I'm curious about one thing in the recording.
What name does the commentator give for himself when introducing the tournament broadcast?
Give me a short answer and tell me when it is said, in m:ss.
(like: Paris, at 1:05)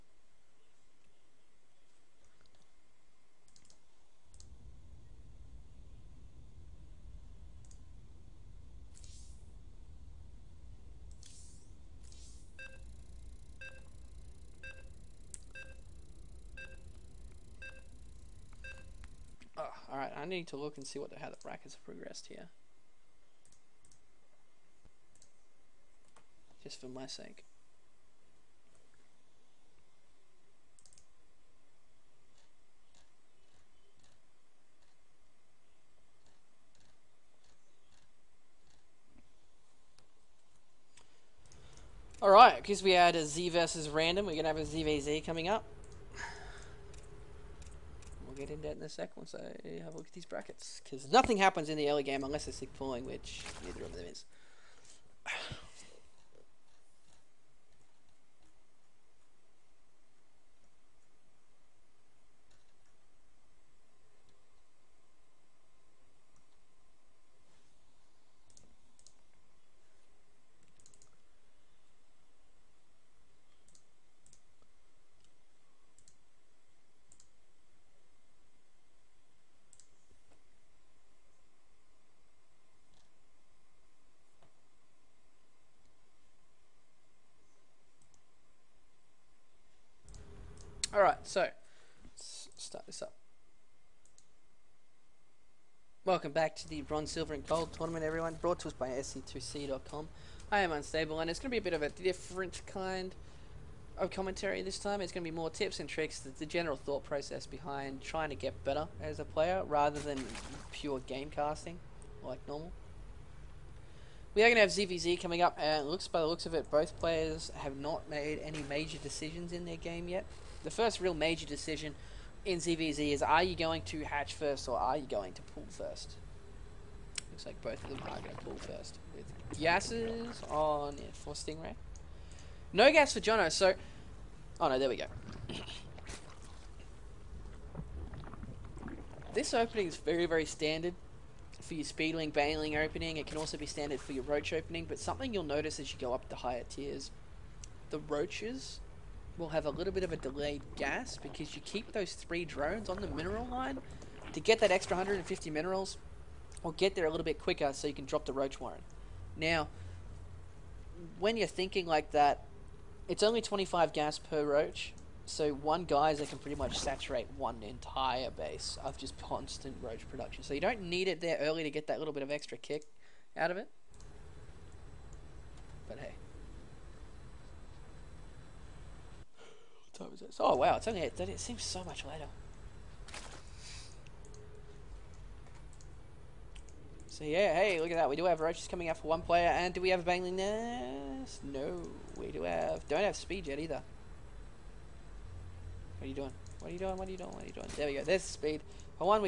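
Unstable, at 1:40.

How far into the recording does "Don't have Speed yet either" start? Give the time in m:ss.
3:12.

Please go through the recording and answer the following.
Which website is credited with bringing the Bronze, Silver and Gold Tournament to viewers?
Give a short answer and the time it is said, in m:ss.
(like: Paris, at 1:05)
SC2C.com, at 1:38.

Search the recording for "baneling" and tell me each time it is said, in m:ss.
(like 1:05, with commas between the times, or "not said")
2:22, 3:10.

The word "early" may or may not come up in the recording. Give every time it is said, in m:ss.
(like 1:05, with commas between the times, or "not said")
0:51, 2:51.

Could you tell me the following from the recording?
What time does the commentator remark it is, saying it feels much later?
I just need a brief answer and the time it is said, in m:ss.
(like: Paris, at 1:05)
8:30, at 3:01.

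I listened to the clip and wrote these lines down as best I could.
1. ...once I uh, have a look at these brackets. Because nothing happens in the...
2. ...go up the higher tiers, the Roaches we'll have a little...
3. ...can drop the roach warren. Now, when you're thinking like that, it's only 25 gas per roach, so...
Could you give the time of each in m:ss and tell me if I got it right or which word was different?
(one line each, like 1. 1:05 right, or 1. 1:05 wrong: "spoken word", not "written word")
1. 0:49 right
2. 2:25 right
3. 2:37 right.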